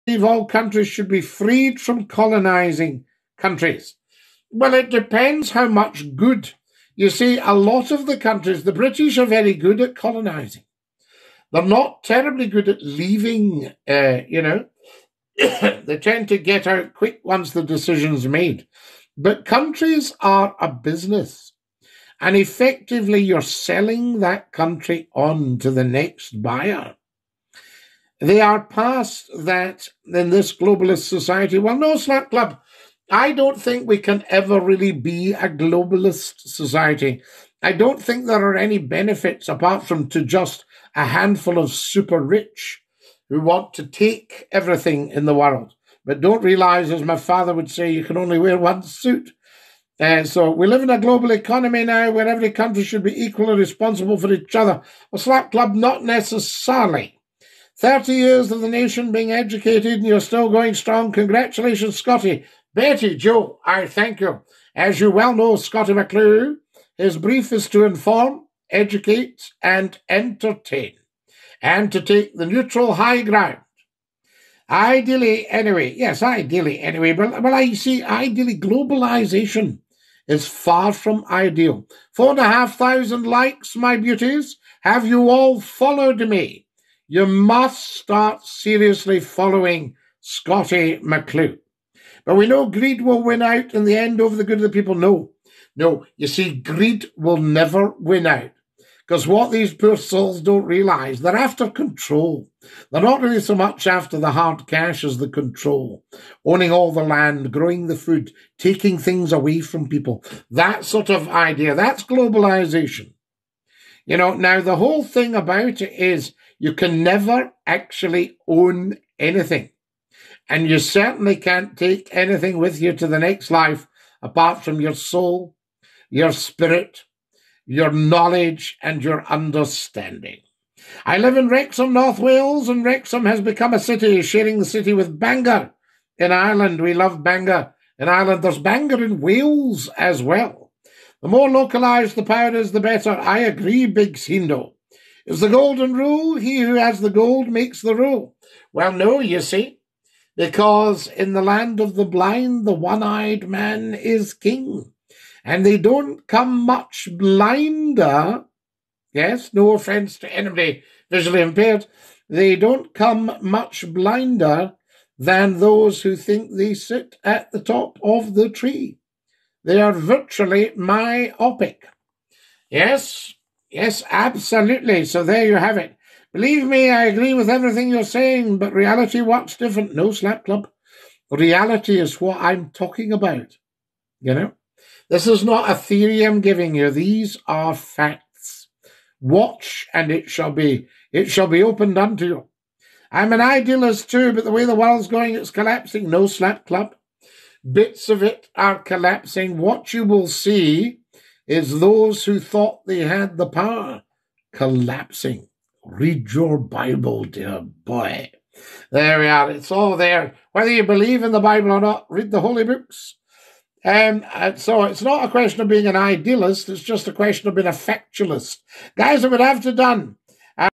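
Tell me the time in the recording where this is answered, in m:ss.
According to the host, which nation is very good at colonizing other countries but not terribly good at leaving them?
0:08.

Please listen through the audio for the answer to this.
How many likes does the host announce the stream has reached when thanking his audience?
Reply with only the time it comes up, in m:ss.
1:22.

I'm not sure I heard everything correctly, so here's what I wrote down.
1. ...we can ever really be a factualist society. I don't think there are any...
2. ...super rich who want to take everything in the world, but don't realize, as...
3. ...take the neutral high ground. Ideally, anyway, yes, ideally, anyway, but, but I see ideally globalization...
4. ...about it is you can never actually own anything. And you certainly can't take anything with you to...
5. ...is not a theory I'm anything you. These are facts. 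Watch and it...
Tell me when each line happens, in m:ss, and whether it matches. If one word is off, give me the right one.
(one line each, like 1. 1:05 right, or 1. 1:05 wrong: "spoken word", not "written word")
1. 0:33 wrong: "globalist", not "factualist"
2. 0:41 right
3. 1:12 right
4. 1:55 right
5. 3:05 wrong: "giving", not "anything".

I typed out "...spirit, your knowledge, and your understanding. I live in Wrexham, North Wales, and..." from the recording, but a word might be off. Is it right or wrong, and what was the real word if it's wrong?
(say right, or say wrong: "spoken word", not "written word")
right.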